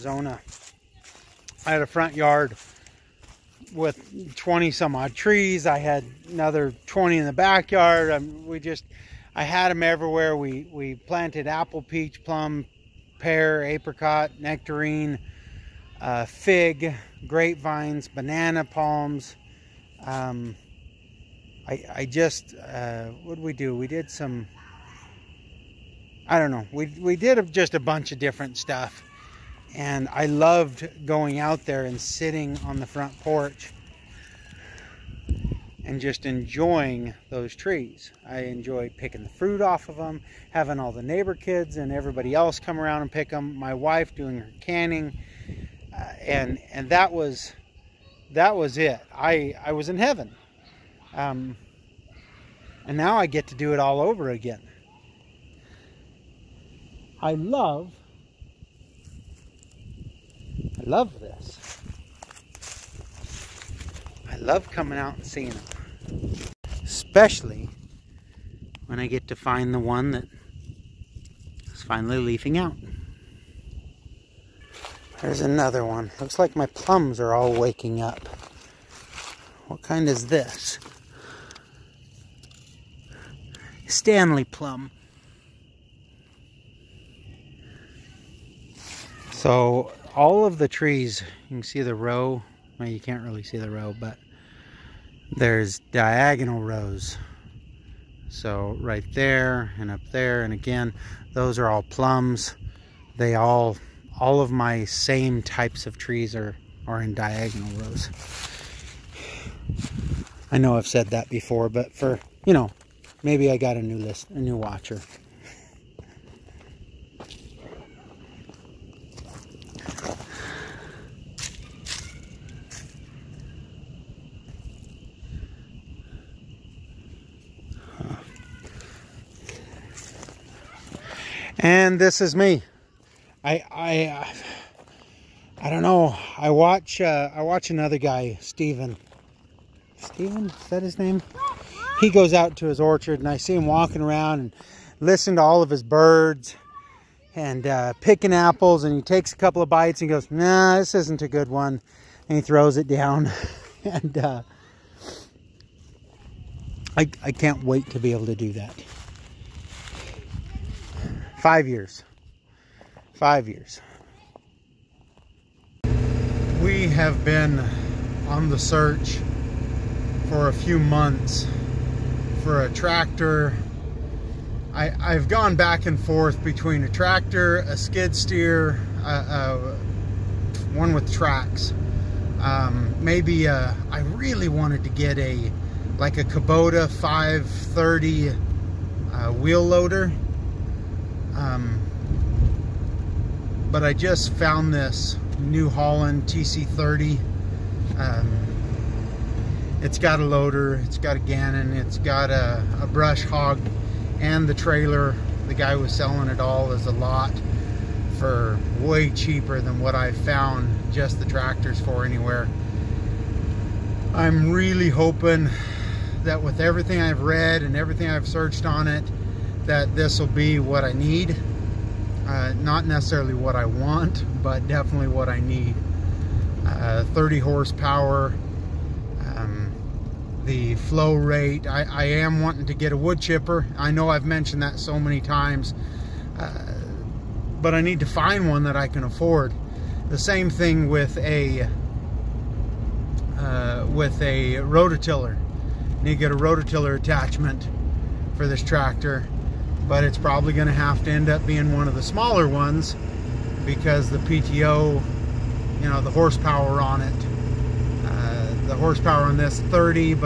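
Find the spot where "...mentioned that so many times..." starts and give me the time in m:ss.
3:54.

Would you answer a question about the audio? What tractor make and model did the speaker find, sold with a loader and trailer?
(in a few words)
New Holland TC30.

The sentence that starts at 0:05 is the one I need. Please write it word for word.
I had another 20 in the backyard.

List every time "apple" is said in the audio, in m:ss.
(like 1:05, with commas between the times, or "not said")
0:11, 2:28.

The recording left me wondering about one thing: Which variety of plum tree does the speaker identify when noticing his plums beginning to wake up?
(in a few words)
Stanley.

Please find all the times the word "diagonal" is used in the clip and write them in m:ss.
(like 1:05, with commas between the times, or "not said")
1:35, 1:47.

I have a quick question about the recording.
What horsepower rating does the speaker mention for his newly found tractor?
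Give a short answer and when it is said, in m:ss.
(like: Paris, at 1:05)
30, at 3:47.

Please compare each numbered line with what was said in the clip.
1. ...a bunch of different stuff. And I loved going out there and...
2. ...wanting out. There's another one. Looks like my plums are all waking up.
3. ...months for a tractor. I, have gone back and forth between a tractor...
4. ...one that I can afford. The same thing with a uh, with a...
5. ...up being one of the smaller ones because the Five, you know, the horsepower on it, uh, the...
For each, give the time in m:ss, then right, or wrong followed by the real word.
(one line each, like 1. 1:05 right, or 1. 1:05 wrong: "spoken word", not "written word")
1. 0:27 right
2. 1:12 wrong: "leafing", not "wanting"
3. 2:50 right
4. 3:58 right
5. 4:11 wrong: "PTO", not "Five".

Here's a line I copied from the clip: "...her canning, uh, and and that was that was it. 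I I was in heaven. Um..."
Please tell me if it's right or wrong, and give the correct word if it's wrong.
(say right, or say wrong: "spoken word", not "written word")
right.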